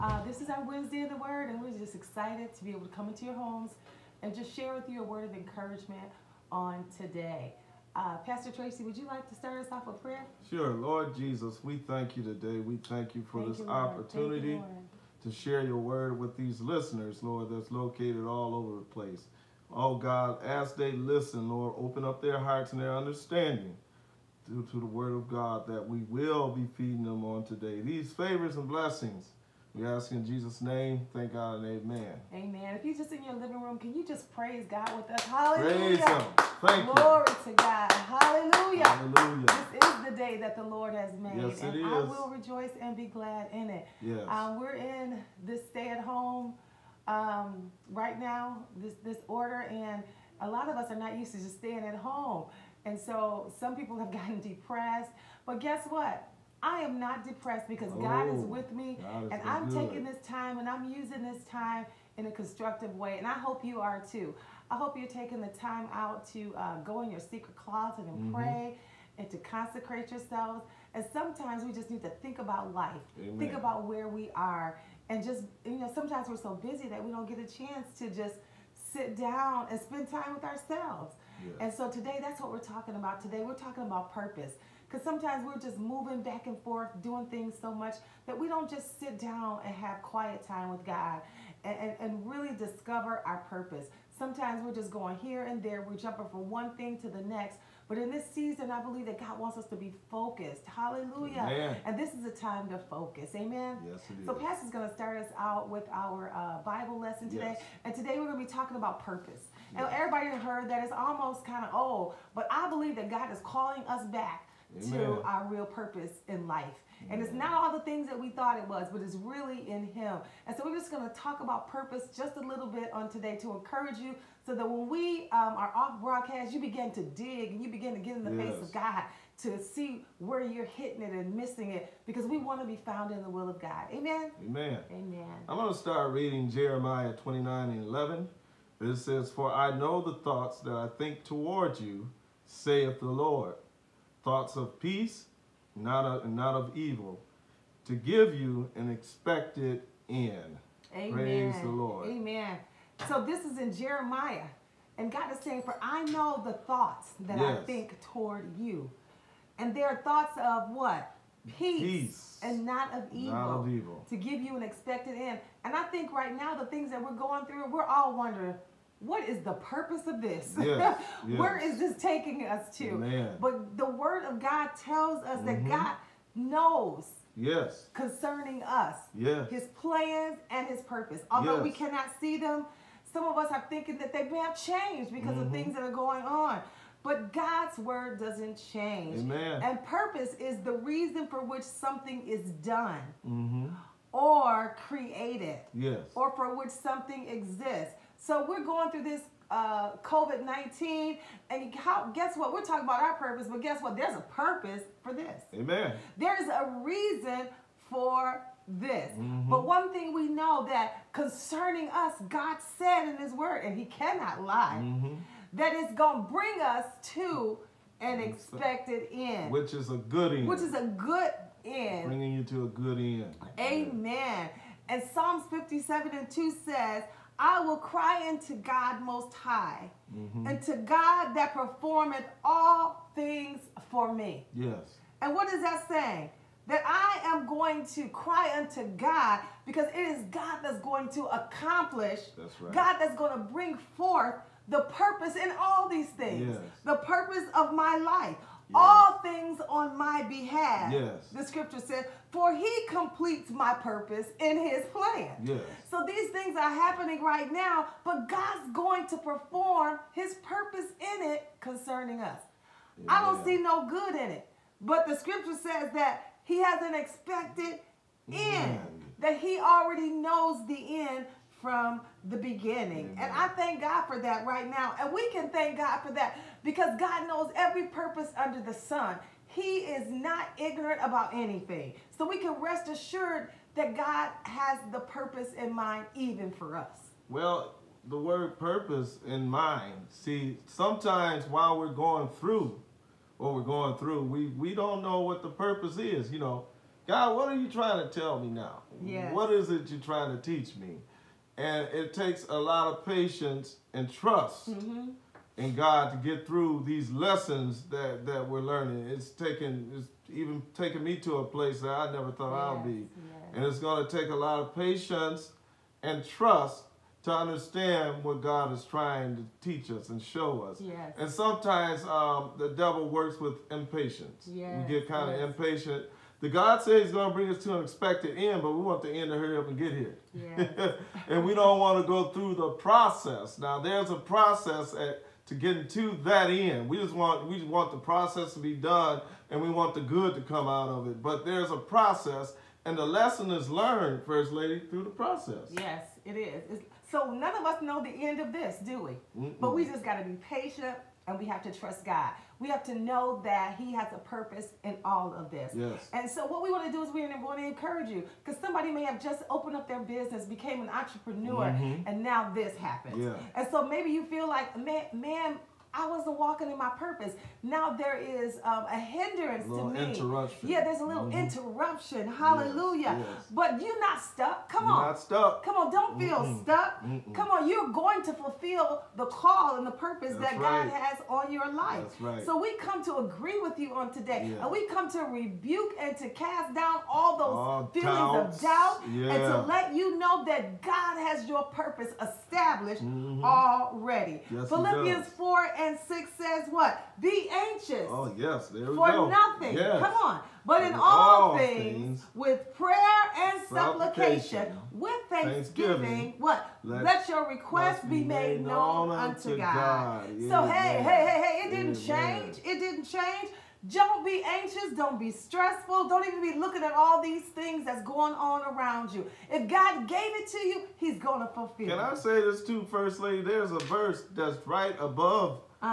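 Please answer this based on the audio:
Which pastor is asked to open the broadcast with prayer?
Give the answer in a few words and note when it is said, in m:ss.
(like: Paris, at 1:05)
Pastor Tracy, at 0:08.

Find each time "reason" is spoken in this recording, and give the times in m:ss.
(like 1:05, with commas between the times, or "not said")
3:10, 3:26.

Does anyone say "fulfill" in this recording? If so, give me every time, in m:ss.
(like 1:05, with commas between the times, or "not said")
6:18, 7:01.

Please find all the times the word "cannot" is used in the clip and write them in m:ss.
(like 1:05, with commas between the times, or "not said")
3:01, 3:33.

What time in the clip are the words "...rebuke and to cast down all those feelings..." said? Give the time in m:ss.
6:25.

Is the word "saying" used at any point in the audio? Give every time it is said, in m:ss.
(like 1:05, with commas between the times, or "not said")
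2:35, 3:55.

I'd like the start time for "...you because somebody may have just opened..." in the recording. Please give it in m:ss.
5:58.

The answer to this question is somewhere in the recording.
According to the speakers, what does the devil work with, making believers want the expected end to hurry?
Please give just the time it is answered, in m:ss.
5:23.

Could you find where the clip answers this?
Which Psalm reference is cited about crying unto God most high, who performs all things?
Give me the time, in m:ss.
3:45.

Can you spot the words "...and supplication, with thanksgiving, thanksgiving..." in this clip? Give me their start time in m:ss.
6:43.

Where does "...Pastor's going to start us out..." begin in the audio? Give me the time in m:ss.
1:44.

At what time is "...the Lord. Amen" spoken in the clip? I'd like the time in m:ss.
2:31.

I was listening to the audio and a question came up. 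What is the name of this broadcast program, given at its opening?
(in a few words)
Wednesday in the Word.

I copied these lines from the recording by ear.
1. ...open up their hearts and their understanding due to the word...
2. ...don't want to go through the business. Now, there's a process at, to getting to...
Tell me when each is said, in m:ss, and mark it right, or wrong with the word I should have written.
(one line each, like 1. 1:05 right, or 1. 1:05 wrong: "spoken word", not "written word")
1. 0:21 right
2. 5:31 wrong: "process", not "business".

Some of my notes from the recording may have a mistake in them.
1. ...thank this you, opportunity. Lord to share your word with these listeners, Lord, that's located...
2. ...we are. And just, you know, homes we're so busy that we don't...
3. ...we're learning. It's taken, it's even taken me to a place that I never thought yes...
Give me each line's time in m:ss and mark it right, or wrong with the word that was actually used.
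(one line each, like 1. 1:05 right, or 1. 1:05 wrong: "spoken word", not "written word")
1. 0:13 right
2. 1:14 wrong: "sometimes", not "homes"
3. 5:08 right.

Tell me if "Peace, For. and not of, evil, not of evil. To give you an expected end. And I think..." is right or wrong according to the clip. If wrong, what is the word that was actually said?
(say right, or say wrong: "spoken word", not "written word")
wrong: "Peace", not "For".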